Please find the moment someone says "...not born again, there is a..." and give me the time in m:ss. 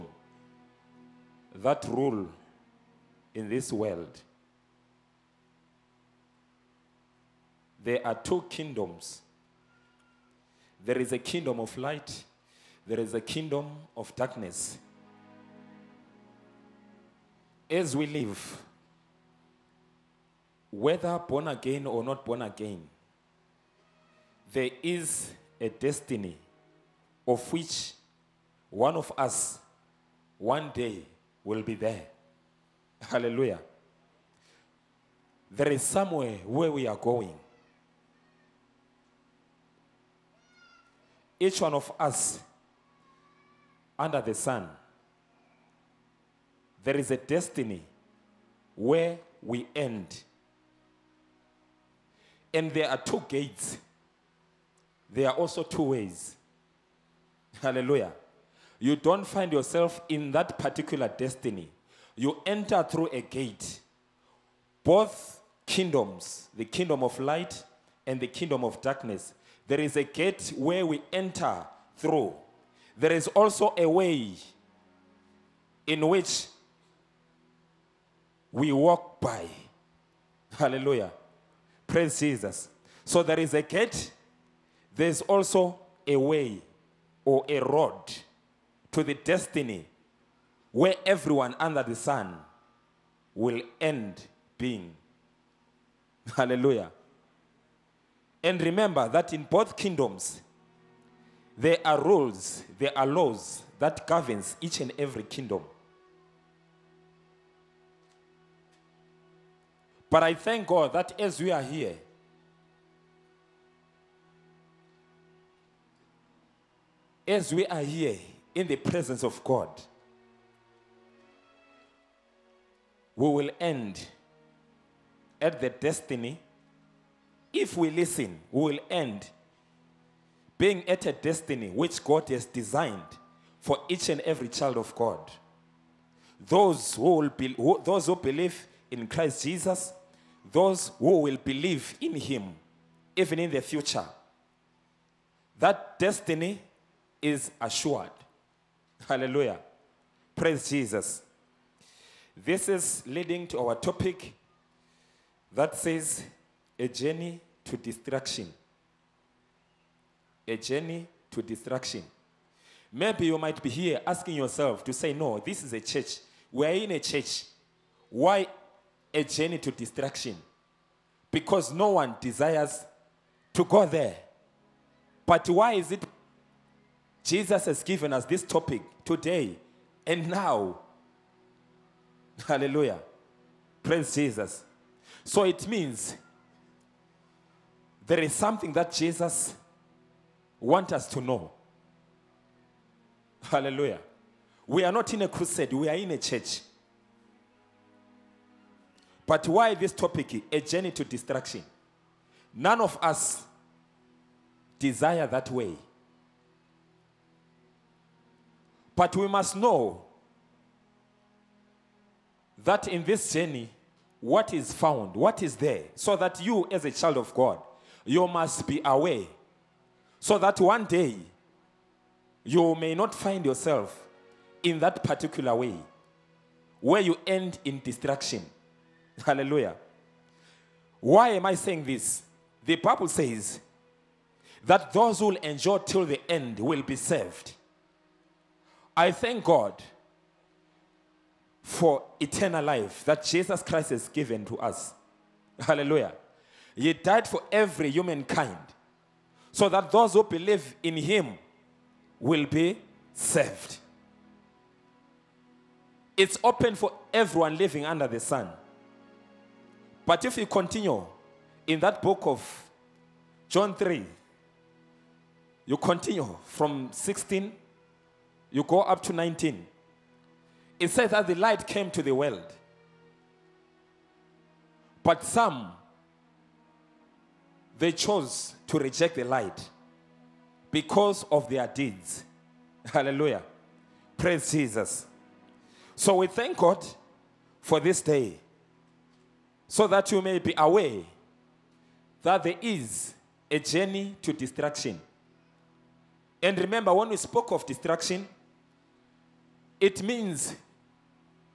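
0:22.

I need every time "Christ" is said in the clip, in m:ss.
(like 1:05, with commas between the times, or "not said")
2:19, 4:03.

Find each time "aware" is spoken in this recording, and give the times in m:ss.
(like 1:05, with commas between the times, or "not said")
3:38, 4:50.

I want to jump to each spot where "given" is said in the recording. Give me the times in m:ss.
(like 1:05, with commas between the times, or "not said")
2:57, 4:04.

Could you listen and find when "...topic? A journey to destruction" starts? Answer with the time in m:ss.
3:19.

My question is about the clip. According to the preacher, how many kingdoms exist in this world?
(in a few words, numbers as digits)
2.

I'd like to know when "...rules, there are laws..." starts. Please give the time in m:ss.
1:42.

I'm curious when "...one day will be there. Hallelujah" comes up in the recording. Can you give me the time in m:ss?
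0:30.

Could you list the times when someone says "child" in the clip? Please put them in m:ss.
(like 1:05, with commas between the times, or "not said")
2:14, 3:36.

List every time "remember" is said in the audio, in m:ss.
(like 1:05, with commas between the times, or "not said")
1:38, 4:56.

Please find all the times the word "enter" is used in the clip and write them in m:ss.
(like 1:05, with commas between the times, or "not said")
1:02, 1:11.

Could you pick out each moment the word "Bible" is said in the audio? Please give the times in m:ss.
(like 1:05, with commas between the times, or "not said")
3:52.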